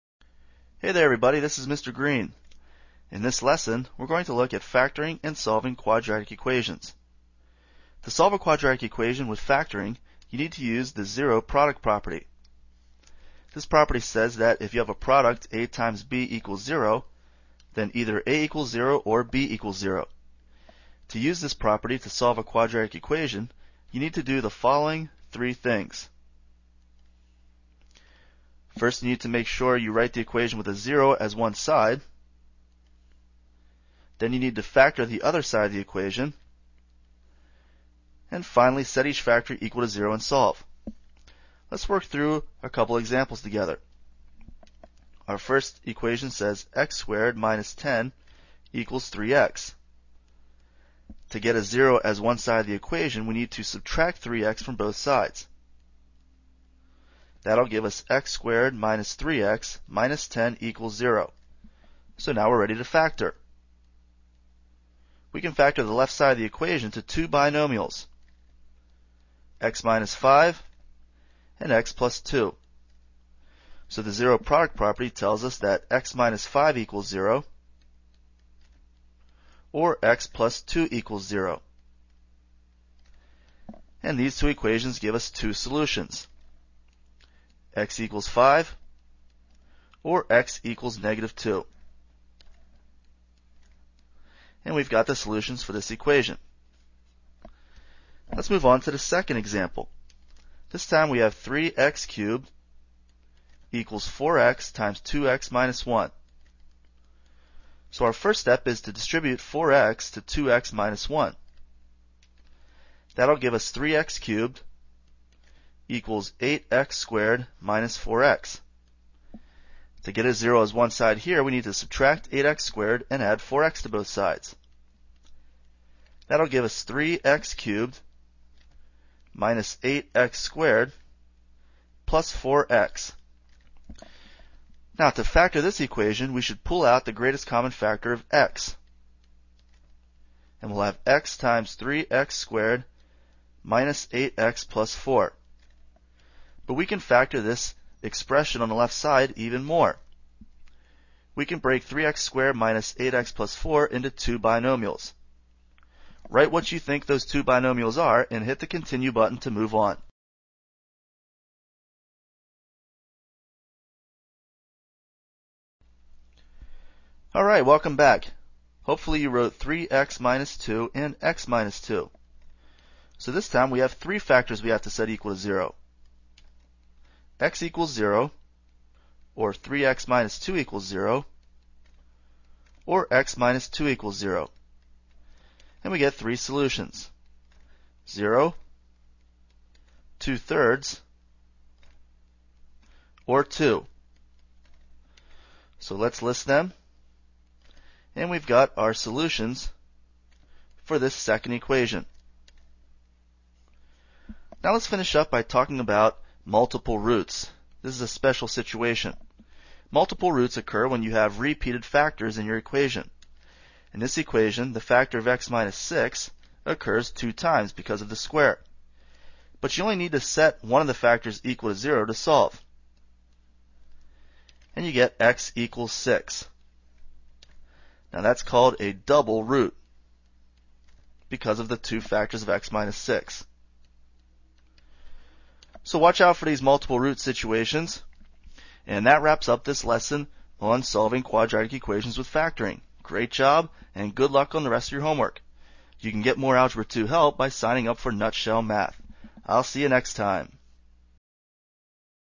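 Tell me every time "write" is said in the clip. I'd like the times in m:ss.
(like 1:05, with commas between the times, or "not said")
0:29, 2:36.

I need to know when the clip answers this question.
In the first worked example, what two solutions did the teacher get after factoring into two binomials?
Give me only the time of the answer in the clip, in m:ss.
1:27.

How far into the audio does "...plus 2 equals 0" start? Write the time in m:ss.
1:20.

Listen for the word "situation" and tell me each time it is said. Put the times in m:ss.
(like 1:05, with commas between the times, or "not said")
3:28, 3:57.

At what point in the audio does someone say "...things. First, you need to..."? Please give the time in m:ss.
0:25.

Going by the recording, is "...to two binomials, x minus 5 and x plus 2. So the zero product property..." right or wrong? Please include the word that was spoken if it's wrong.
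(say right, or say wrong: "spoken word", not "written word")
right.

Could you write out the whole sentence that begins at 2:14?
Now to factor this equation, we should pull out the greatest common factor of x.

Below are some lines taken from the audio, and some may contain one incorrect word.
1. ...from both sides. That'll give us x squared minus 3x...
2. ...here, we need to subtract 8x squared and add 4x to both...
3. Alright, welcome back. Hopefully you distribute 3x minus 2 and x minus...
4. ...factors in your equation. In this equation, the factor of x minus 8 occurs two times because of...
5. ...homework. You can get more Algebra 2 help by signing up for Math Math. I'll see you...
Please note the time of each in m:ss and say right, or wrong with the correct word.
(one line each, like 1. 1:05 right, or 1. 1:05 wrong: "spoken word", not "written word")
1. 0:54 right
2. 2:01 right
3. 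2:47 wrong: "wrote", not "distribute"
4. 3:31 wrong: "6", not "8"
5. 4:05 wrong: "Nutshell", not "Math".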